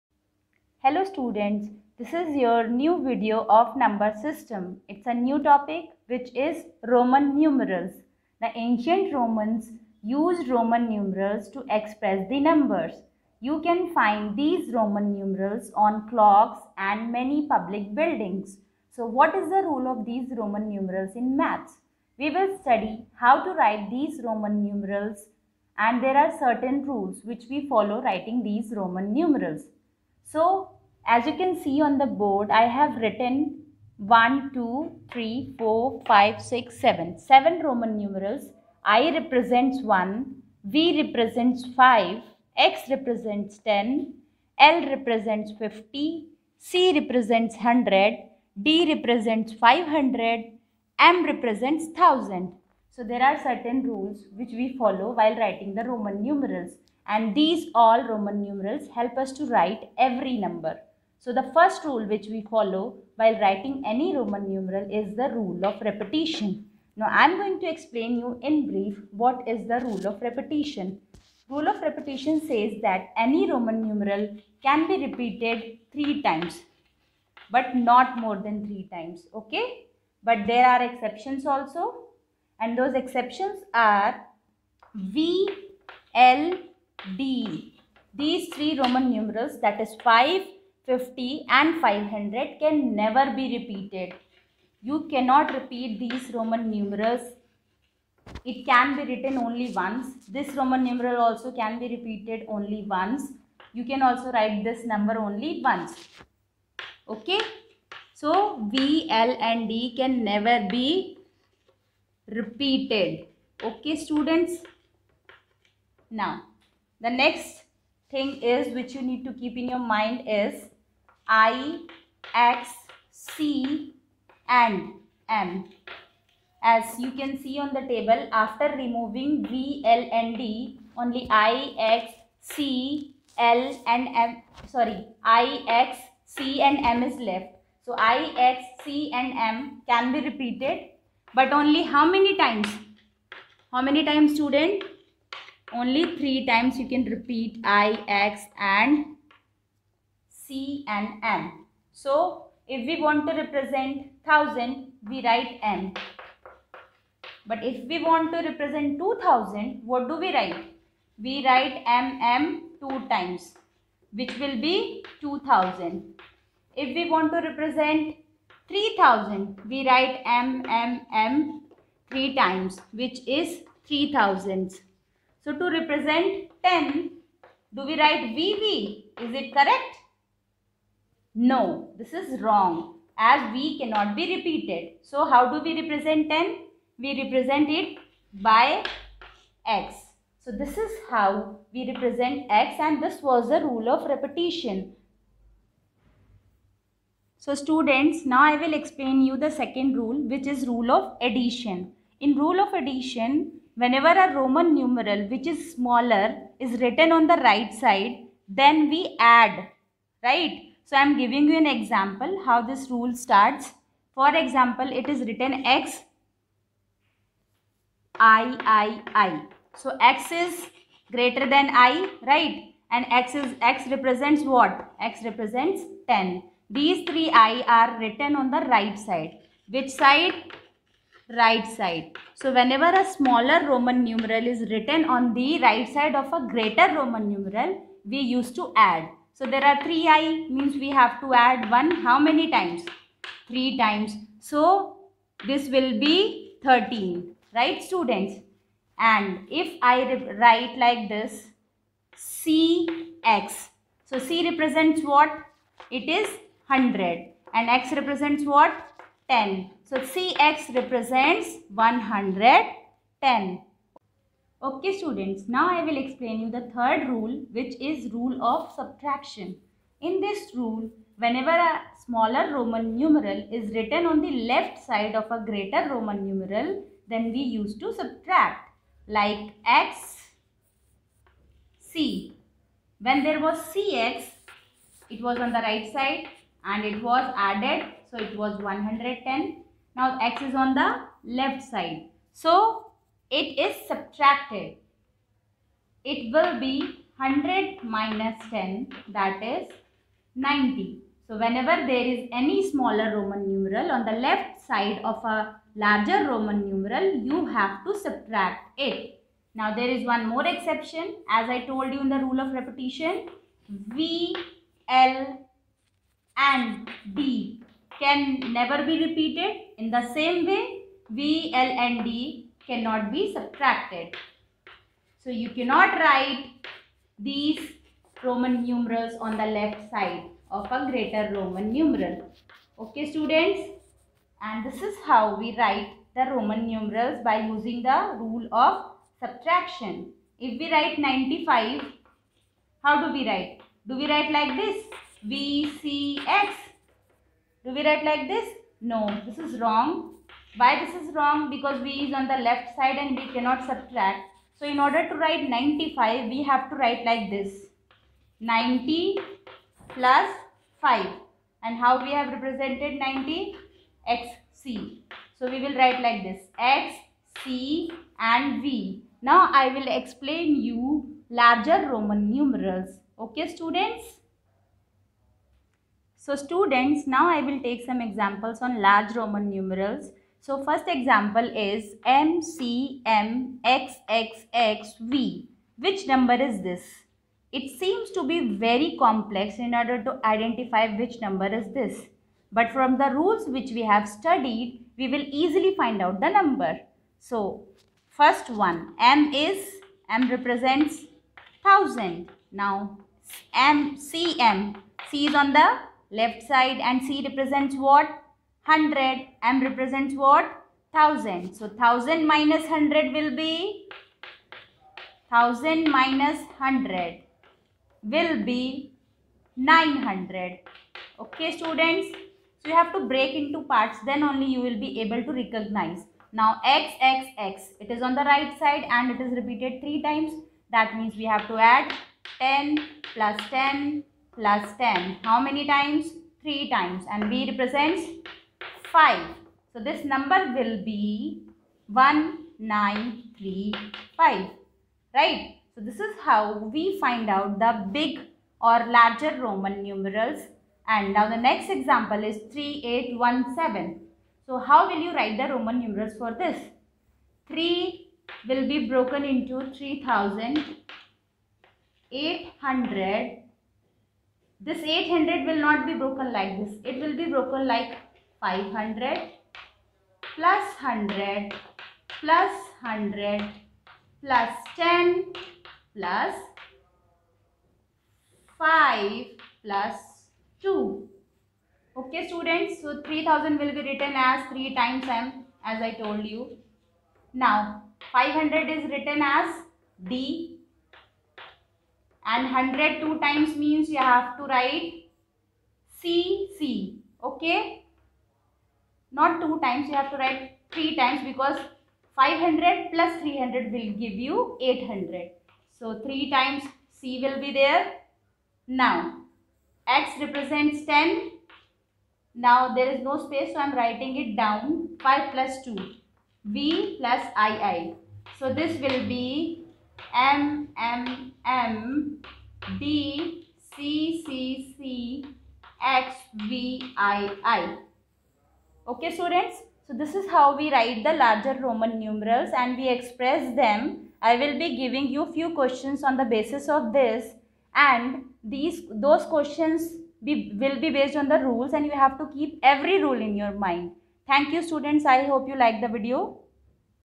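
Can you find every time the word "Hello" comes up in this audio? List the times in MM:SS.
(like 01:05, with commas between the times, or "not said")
00:00.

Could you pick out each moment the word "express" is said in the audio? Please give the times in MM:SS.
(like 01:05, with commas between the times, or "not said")
00:11, 08:52.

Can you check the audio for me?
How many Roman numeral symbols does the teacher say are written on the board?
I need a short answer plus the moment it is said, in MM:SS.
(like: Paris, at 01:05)
7, at 00:37.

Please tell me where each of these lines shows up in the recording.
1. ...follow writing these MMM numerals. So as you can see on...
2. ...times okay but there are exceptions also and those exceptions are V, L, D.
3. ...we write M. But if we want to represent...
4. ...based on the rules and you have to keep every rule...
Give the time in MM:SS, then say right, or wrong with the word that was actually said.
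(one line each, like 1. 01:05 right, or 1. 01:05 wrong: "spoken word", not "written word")
1. 00:27 wrong: "Roman", not "MMM"
2. 01:18 right
3. 02:35 right
4. 09:00 right.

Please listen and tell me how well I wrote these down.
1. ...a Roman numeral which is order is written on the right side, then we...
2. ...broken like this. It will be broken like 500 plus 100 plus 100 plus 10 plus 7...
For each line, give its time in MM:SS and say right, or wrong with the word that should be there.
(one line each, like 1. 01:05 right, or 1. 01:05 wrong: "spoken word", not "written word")
1. 03:24 wrong: "smaller", not "order"
2. 07:45 wrong: "5", not "7".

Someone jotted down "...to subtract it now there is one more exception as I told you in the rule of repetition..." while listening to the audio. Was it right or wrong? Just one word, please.
right.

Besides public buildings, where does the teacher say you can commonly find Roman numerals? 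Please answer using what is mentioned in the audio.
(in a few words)
Clocks.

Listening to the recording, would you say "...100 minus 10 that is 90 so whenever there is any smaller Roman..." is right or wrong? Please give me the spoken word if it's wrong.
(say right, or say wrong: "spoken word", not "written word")
right.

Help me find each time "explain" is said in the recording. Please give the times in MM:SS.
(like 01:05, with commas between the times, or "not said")
01:07, 03:18, 04:25, 06:09.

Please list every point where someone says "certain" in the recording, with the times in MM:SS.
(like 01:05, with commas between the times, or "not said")
00:26, 00:53.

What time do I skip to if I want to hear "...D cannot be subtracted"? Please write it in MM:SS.
05:22.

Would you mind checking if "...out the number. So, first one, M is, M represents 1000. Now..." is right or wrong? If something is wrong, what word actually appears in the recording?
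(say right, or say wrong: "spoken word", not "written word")
right.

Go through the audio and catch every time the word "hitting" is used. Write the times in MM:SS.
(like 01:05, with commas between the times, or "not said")
not said.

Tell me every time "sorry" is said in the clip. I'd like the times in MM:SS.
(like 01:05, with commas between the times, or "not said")
02:14.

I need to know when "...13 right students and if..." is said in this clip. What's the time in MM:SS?
04:06.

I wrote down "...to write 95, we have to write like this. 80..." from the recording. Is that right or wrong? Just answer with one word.
wrong.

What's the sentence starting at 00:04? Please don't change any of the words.
It's a new topic which is Roman numerals.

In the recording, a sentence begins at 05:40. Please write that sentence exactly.
If we write 95, how do we write?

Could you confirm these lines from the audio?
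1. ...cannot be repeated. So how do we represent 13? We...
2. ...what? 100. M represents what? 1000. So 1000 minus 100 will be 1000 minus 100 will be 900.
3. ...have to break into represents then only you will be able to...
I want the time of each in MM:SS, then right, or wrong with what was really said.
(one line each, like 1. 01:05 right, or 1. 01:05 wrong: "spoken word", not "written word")
1. 03:03 wrong: "10", not "13"
2. 06:47 right
3. 07:02 wrong: "parts", not "represents".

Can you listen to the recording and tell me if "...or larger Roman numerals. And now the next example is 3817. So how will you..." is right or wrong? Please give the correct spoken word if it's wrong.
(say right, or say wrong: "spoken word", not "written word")
right.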